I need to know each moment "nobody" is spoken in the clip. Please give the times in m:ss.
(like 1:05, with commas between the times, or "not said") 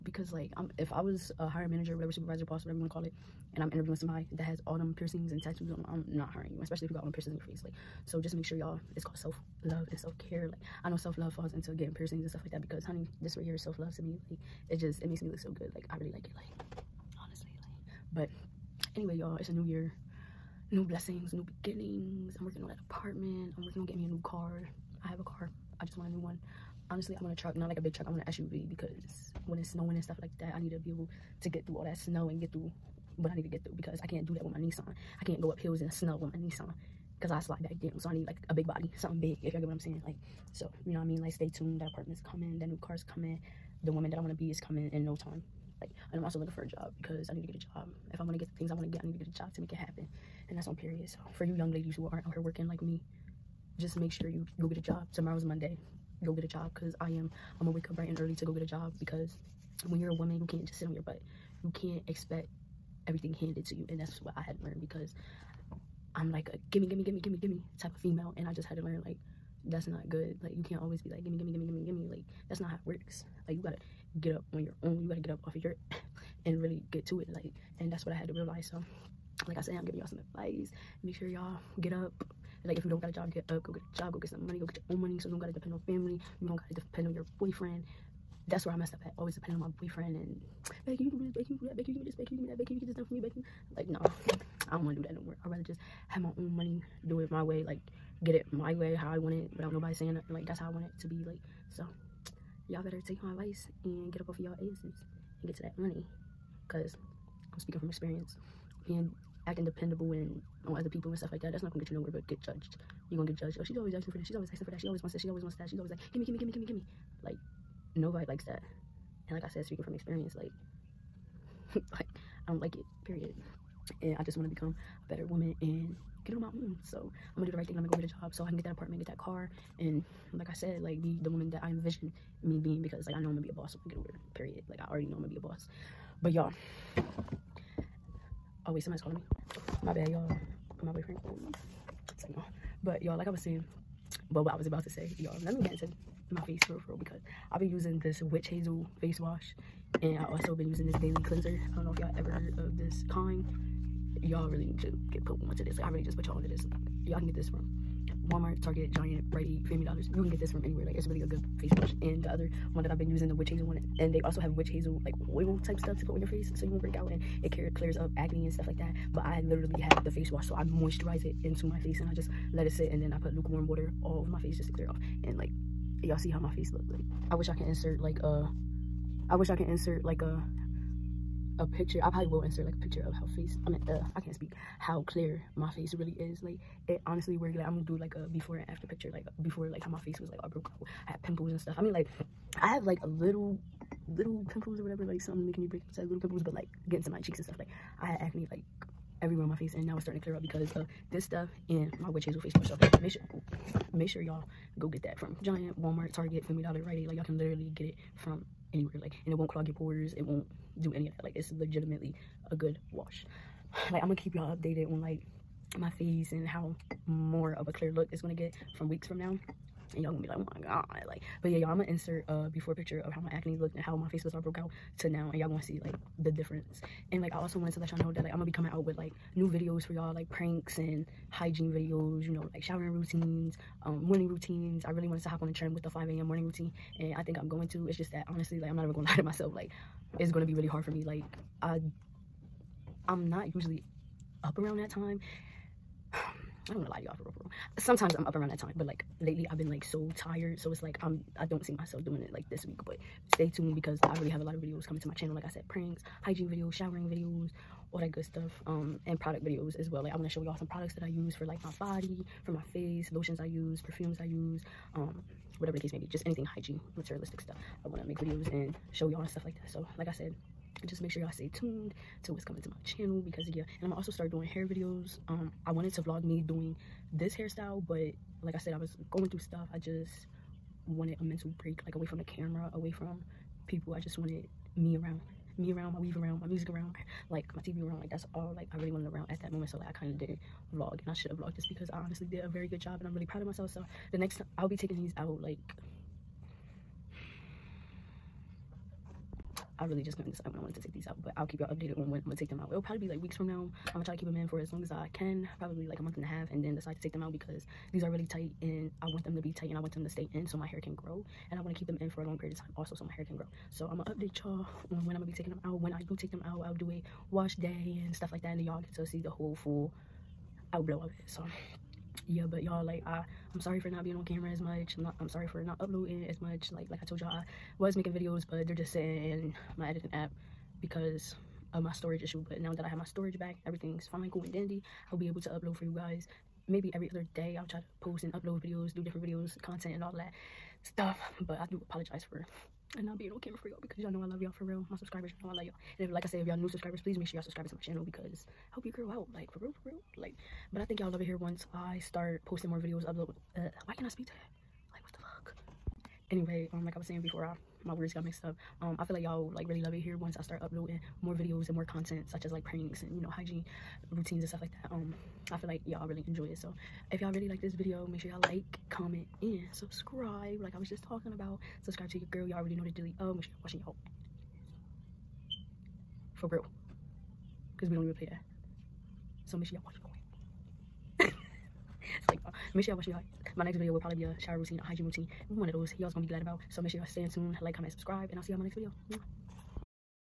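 1:39, 1:57.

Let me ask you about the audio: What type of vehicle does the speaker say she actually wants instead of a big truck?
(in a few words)
SUV.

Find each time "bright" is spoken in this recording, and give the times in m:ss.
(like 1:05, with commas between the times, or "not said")
0:57.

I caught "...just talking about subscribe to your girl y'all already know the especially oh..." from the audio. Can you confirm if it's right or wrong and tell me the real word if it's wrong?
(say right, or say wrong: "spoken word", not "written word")
wrong: "dilly", not "especially".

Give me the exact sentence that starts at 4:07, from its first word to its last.
Sometimes I'm up around that time, but like lately I've been like so tired.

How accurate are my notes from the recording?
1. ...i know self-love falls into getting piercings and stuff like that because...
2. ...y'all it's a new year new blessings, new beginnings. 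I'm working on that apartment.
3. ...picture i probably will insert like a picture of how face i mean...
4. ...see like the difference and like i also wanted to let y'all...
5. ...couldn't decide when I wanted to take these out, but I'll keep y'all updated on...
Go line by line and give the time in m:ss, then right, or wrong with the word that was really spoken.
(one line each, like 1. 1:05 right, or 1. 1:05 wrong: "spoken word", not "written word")
1. 0:10 right
2. 0:19 right
3. 3:01 right
4. 3:45 right
5. 5:00 right.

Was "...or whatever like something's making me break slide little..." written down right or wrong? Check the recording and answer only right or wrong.
wrong.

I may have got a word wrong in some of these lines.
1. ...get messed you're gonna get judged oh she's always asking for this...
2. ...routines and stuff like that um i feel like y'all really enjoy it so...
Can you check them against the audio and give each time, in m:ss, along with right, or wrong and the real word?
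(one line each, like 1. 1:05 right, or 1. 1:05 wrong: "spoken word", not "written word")
1. 1:52 wrong: "judged", not "messed"
2. 6:04 right.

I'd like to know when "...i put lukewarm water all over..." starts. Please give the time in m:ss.
2:53.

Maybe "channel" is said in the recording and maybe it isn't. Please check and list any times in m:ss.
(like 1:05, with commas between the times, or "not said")
4:15, 4:32, 5:47.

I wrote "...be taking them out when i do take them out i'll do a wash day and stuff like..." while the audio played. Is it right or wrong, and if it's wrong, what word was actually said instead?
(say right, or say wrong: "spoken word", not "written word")
right.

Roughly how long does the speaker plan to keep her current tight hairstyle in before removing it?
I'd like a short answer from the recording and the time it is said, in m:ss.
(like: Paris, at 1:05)
a month and a half, at 5:05.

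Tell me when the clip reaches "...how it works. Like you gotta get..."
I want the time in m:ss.
1:12.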